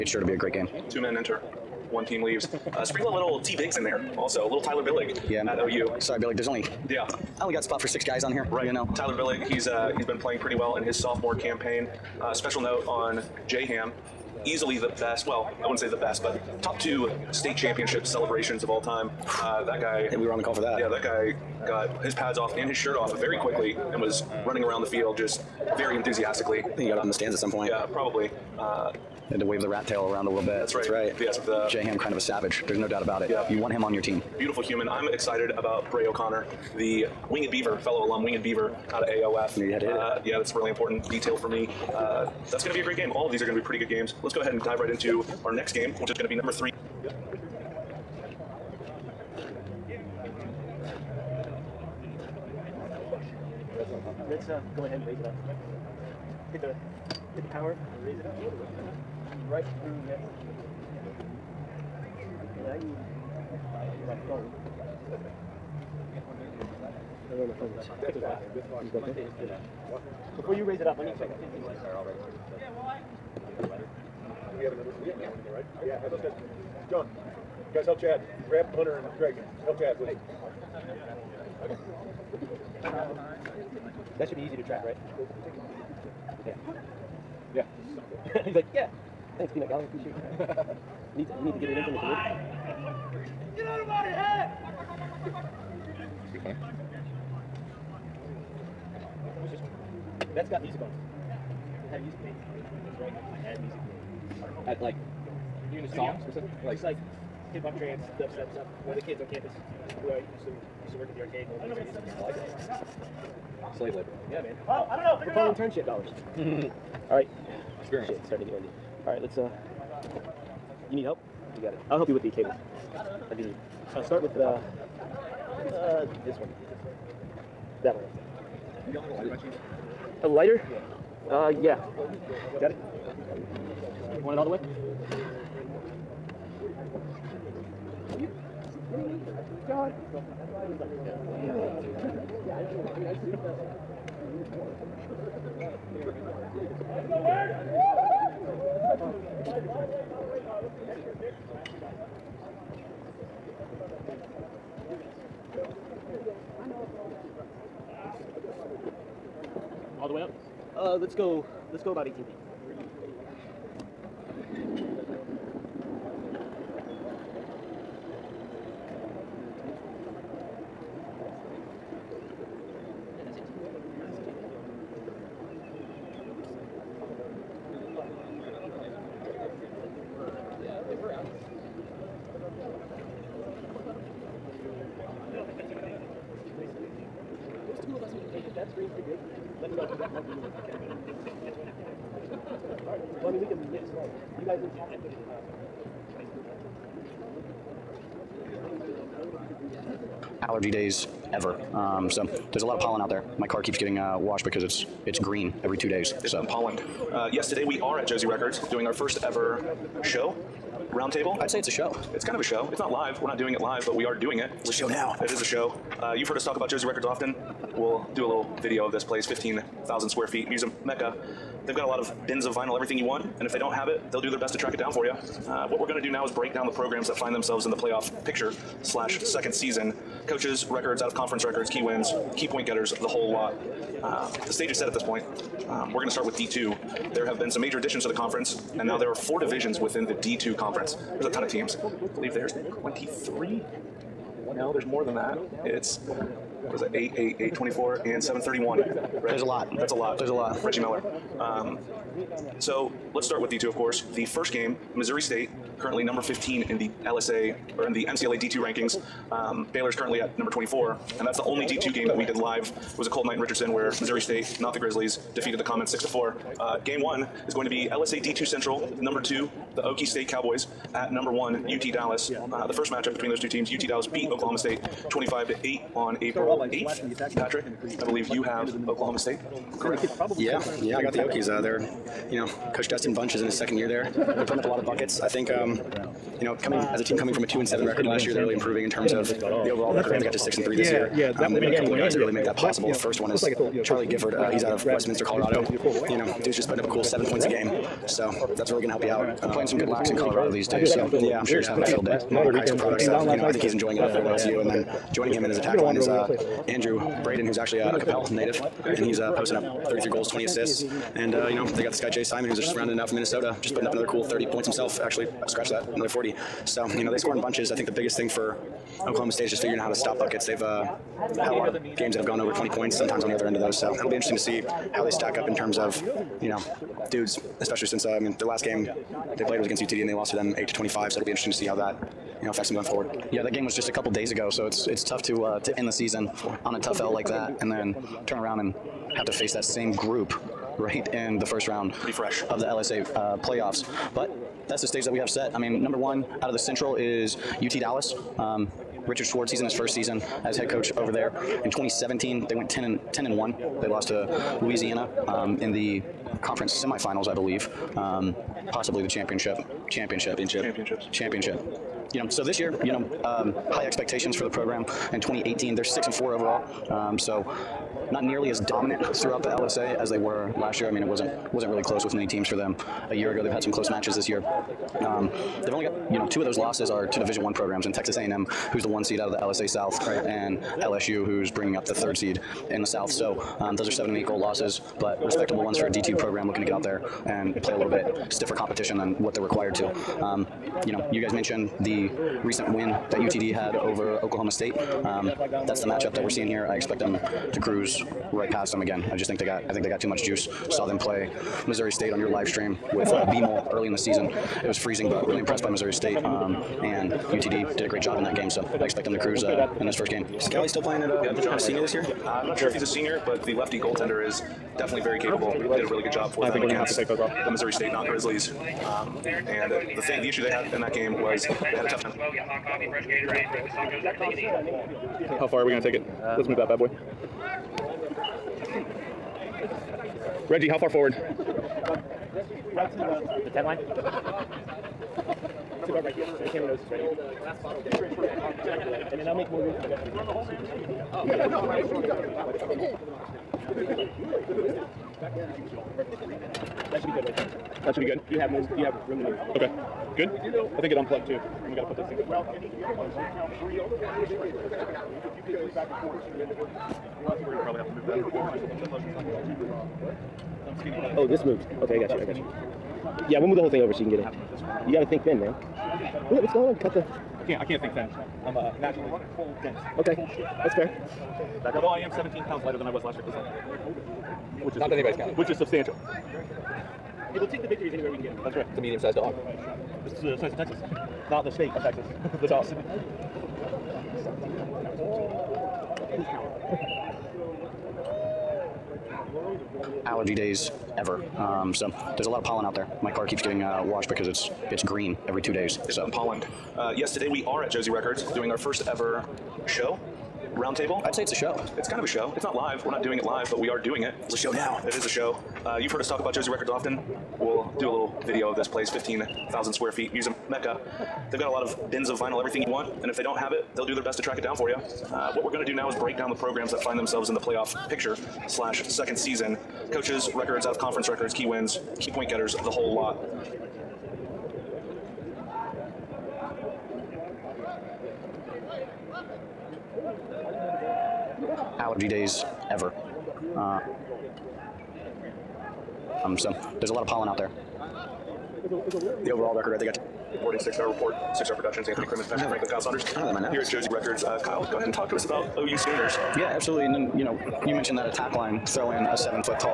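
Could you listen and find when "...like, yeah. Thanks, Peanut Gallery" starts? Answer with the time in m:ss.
1:28.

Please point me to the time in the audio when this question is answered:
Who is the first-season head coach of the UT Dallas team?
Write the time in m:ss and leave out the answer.
5:49.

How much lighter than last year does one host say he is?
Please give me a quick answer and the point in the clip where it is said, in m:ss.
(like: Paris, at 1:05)
17 pounds, at 7:52.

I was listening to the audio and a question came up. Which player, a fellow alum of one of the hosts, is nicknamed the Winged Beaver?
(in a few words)
Bray O'Connor.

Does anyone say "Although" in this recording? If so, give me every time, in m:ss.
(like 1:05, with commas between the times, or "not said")
7:51.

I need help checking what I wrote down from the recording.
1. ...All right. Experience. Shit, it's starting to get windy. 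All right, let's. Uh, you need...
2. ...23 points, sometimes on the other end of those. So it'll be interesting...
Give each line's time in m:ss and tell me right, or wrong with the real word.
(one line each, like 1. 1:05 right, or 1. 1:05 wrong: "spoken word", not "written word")
1. 1:57 right
2. 5:22 wrong: "20", not "23".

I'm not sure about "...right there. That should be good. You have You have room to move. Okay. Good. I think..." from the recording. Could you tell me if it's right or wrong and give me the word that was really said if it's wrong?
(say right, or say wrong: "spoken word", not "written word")
right.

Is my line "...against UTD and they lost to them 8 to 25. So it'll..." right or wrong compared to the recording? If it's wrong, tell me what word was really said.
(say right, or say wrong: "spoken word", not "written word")
right.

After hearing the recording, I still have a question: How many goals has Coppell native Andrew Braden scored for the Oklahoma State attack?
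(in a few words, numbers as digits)
33.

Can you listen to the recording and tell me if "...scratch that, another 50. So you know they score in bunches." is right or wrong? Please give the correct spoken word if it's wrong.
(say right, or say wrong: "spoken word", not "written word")
wrong: "40", not "50".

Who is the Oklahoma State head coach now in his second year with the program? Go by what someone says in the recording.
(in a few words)
Dustin Bunch.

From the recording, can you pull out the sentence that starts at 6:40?
Saw them play Missouri State on your live stream with uh, BMO early in the season.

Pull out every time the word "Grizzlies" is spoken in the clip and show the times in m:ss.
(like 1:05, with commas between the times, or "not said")
4:24, 6:58.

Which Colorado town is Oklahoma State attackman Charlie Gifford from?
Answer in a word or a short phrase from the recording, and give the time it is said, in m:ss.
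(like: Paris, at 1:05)
Westminster, at 4:54.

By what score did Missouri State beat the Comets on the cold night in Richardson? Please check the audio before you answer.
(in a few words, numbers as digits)
6 to 4.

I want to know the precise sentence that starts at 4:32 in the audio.
Uh, the first matchup between those two teams, UT Dallas beat Oklahoma State 25 to 8 on April 8th.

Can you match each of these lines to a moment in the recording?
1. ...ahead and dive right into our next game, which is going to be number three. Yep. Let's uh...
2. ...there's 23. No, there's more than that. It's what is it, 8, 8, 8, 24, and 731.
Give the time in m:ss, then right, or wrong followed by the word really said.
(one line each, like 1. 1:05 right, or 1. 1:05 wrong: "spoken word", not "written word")
1. 0:44 right
2. 4:02 right.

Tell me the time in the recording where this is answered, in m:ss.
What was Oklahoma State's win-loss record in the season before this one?
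4:47.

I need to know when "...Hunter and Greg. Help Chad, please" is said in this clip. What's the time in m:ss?
1:18.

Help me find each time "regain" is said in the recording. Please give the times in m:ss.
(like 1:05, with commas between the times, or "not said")
not said.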